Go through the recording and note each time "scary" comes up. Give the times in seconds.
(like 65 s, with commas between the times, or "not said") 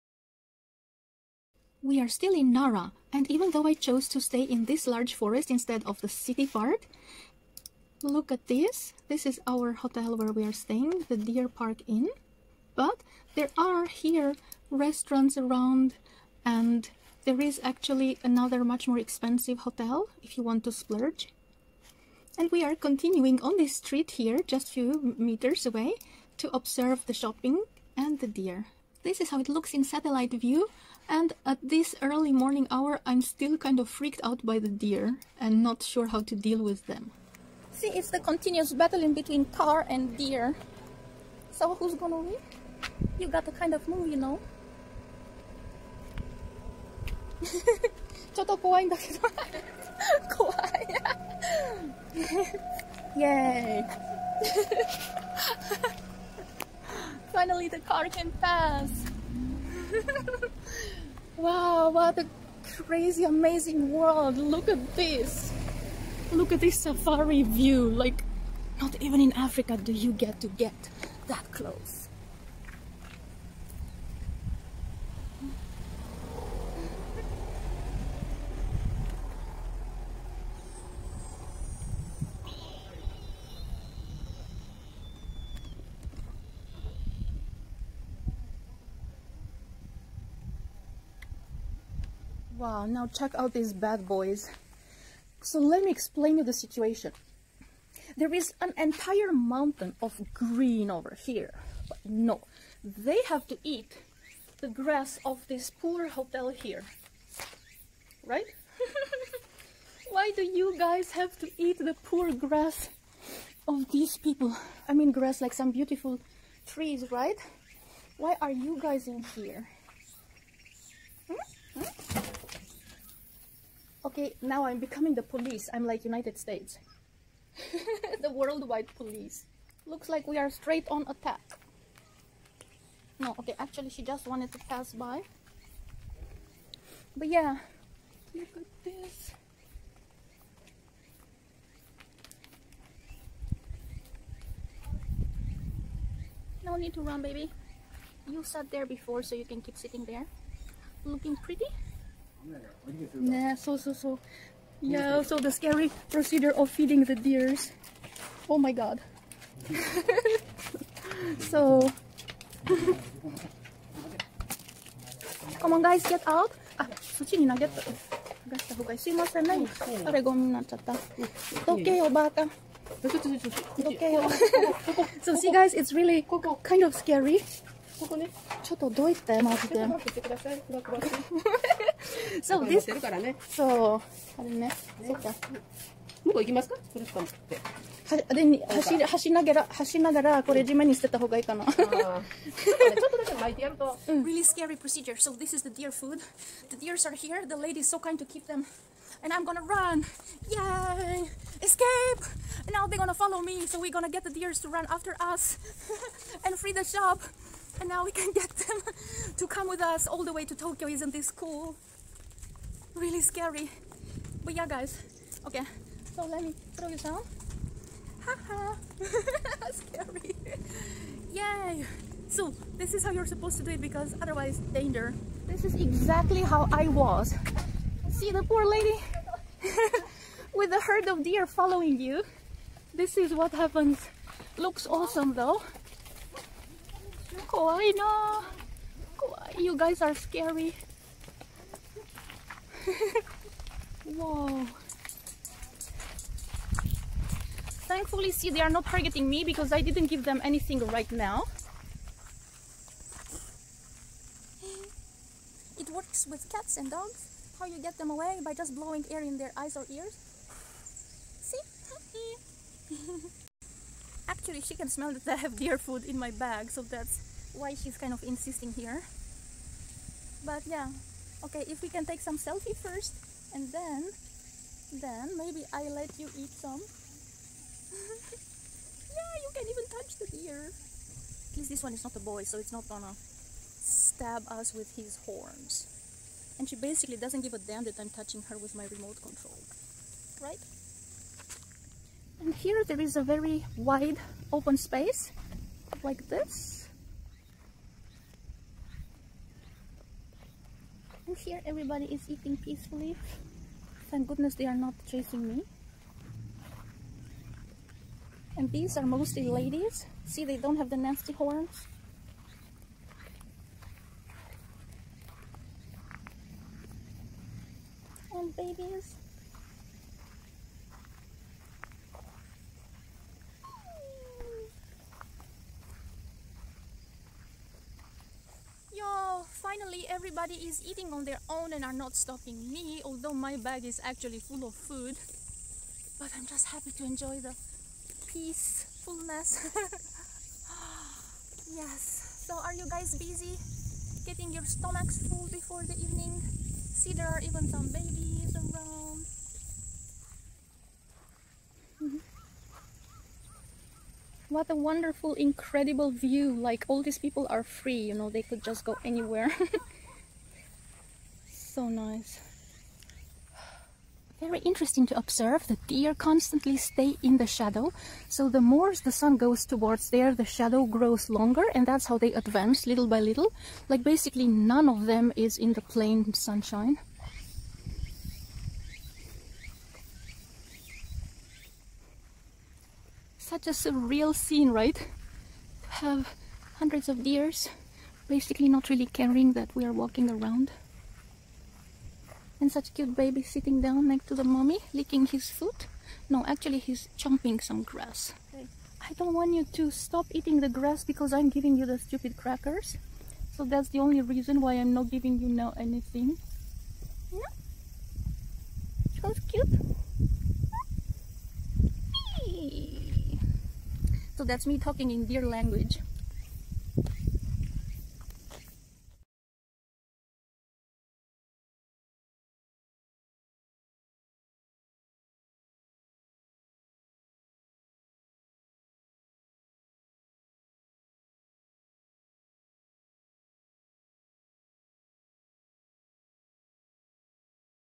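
155 s, 176 s, 194 s, 213 s, 219 s, 240 s.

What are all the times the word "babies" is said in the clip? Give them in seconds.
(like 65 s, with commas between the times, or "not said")
318 s, 347 s.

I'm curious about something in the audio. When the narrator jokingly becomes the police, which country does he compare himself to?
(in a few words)
United States.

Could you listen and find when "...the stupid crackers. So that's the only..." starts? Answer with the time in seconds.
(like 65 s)
401 s.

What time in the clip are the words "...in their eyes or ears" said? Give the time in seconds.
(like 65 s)
259 s.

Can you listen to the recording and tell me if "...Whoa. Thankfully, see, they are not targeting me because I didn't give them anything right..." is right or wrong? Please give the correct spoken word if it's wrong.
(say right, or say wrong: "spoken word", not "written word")
right.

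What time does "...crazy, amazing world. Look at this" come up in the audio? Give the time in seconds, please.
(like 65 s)
62 s.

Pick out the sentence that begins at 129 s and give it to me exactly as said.
Looks like we are straight on attack.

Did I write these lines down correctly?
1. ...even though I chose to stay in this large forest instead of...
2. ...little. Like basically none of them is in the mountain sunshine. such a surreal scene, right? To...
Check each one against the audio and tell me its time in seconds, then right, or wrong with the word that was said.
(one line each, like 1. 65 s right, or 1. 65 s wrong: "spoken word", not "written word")
1. 3 s right
2. 373 s wrong: "plain", not "mountain".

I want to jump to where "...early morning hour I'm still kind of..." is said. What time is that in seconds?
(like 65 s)
32 s.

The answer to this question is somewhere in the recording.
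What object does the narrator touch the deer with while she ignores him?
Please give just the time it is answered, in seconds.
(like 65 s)
288 s.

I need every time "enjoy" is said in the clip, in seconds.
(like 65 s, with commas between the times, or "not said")
337 s.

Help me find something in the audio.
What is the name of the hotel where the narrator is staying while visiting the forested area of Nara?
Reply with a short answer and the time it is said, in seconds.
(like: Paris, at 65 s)
Deer Park Inn, at 11 s.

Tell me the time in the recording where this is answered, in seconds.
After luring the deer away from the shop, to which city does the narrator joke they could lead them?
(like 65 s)
210 s.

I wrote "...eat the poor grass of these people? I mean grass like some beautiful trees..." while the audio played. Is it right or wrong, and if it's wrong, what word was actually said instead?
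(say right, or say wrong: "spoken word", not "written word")
right.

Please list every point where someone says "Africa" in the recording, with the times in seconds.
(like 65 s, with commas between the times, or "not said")
69 s.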